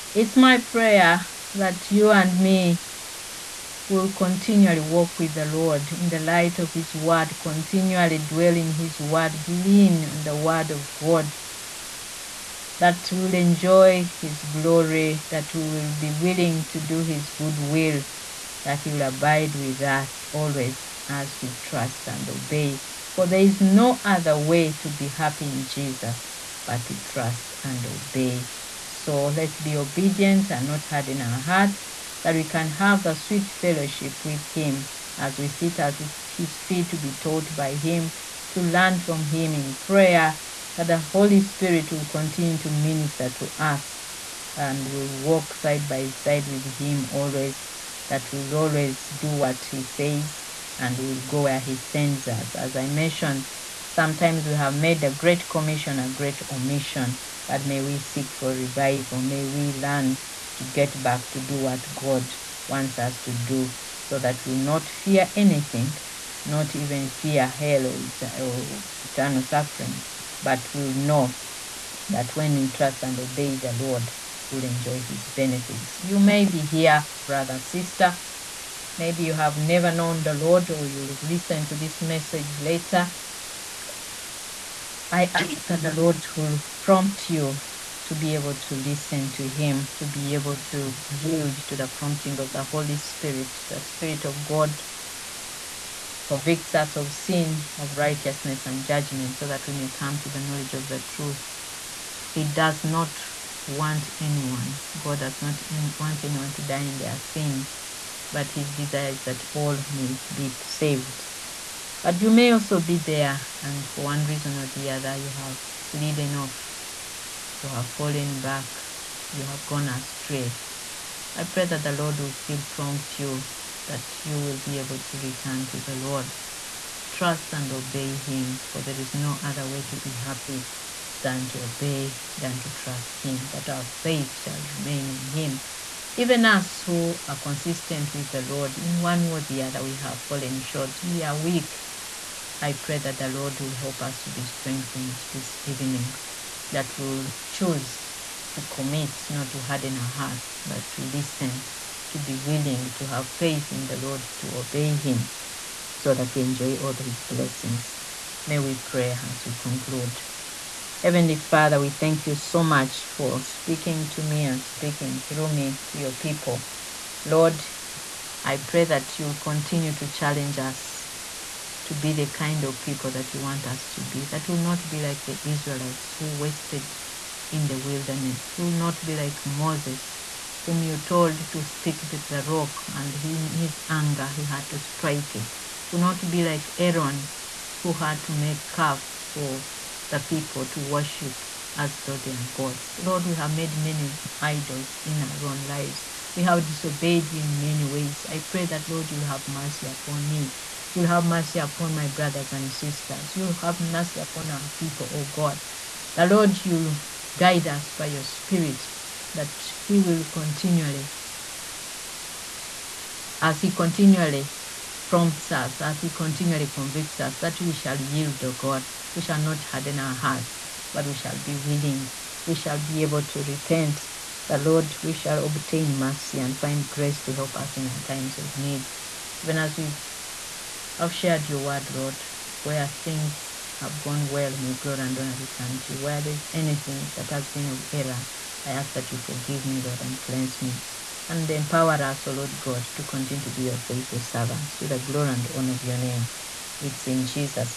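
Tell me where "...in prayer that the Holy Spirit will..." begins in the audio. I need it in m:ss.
0:39.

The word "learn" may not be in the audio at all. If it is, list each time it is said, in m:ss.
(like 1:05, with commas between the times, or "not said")
0:38, 0:59.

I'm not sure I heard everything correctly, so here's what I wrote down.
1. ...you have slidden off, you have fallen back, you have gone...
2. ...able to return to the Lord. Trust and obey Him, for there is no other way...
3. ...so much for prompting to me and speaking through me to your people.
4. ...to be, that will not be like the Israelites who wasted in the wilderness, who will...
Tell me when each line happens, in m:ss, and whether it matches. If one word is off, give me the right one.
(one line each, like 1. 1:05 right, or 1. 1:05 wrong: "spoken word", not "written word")
1. 1:55 right
2. 2:04 right
3. 2:42 wrong: "speaking", not "prompting"
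4. 2:53 right.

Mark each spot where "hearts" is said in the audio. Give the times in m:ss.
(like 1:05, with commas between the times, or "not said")
0:31, 2:30, 3:40.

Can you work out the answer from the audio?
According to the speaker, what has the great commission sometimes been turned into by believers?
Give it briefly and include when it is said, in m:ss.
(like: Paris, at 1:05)
A great omission, at 0:55.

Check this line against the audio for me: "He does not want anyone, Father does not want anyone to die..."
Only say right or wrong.
wrong.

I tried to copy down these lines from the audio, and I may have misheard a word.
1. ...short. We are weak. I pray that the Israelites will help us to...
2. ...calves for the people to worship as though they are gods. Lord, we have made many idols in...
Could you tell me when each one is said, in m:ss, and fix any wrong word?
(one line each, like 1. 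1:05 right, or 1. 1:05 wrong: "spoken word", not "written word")
1. 2:20 wrong: "Lord", not "Israelites"
2. 3:08 right.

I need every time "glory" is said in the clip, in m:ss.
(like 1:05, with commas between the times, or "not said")
0:14, 3:54, 4:04.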